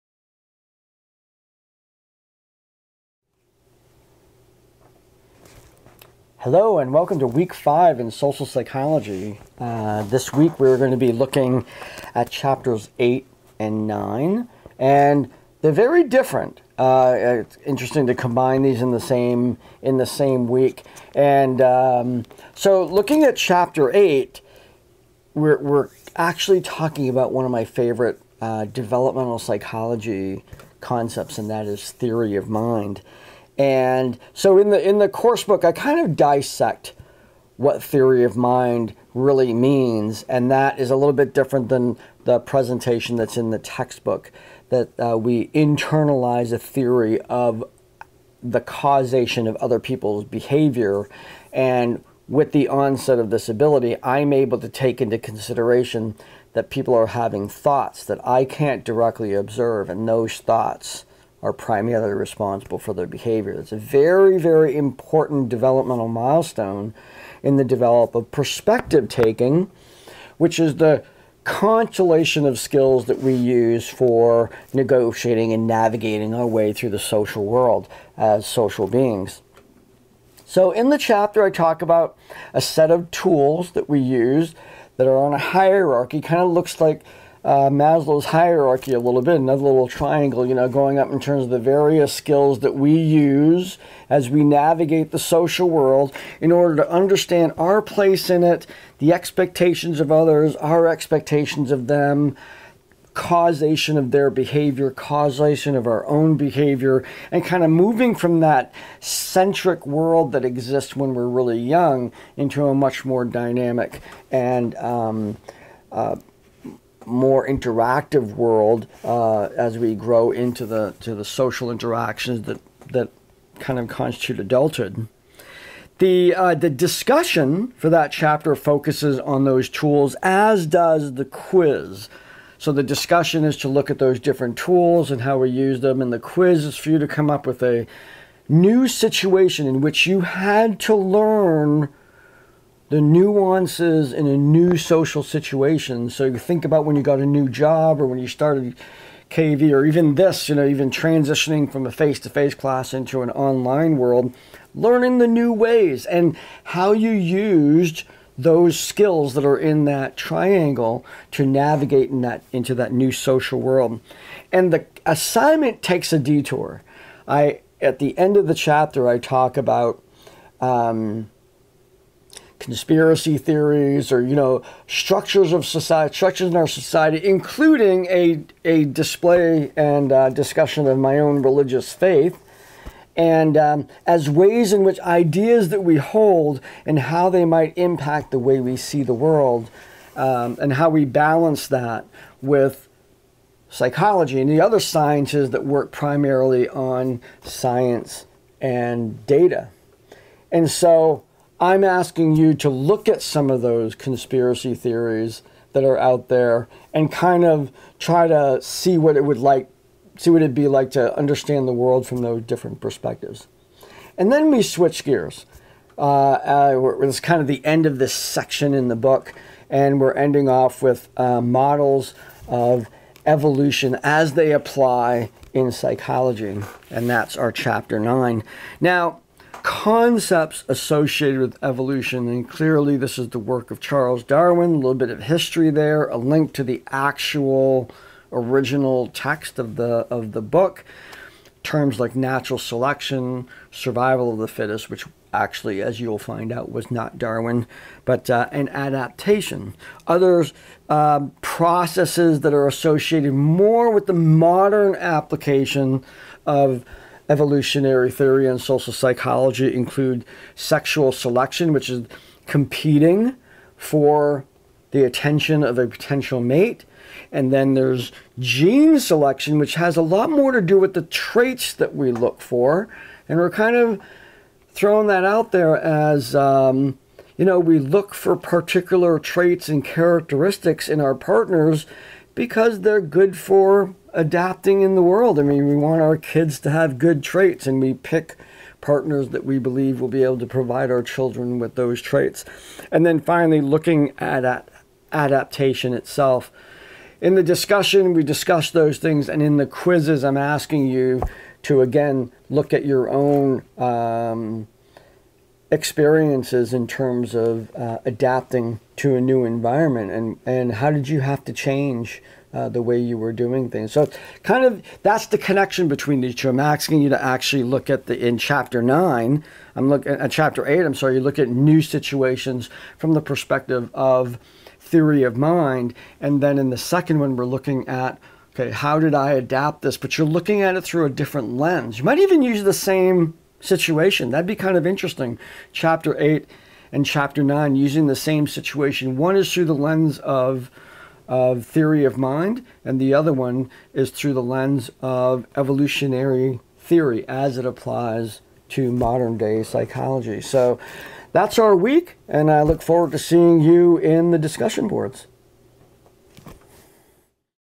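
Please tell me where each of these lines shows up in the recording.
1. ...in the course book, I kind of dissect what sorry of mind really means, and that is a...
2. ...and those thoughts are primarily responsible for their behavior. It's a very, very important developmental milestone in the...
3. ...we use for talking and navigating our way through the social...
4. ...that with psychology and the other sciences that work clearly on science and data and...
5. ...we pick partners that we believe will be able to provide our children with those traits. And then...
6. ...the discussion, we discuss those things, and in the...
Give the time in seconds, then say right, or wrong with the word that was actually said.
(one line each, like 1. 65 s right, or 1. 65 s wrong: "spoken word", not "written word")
1. 34 s wrong: "theory", not "sorry"
2. 59 s right
3. 73 s wrong: "negotiating", not "talking"
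4. 191 s wrong: "primarily", not "clearly"
5. 287 s right
6. 297 s right.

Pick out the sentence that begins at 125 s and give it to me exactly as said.
The, uh, the discussion for that chapter focuses on those tools, as does the quiz.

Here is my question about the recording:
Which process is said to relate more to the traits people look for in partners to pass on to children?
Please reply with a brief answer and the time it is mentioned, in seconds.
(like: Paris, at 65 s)
Gene selection, at 268 s.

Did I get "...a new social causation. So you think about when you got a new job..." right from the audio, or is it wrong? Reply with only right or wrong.
wrong.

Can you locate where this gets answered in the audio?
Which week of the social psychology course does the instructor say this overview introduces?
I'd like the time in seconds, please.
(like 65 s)
7 s.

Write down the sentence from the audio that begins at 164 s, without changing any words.
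And the assignment takes a detour.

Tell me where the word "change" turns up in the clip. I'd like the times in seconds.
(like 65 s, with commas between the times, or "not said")
311 s.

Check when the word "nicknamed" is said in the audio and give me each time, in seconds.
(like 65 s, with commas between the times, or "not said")
not said.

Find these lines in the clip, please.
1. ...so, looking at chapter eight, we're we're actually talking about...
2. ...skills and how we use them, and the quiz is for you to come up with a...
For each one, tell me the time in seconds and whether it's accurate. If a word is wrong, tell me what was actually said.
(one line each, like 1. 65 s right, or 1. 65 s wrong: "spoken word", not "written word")
1. 22 s right
2. 134 s wrong: "tools", not "skills".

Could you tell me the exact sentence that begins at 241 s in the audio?
Terms like natural selection, survival of the fittest, which actually, as you'll find out, was not Darwin, but uh, an adaptation.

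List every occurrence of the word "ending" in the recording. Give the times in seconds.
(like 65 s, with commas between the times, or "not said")
220 s.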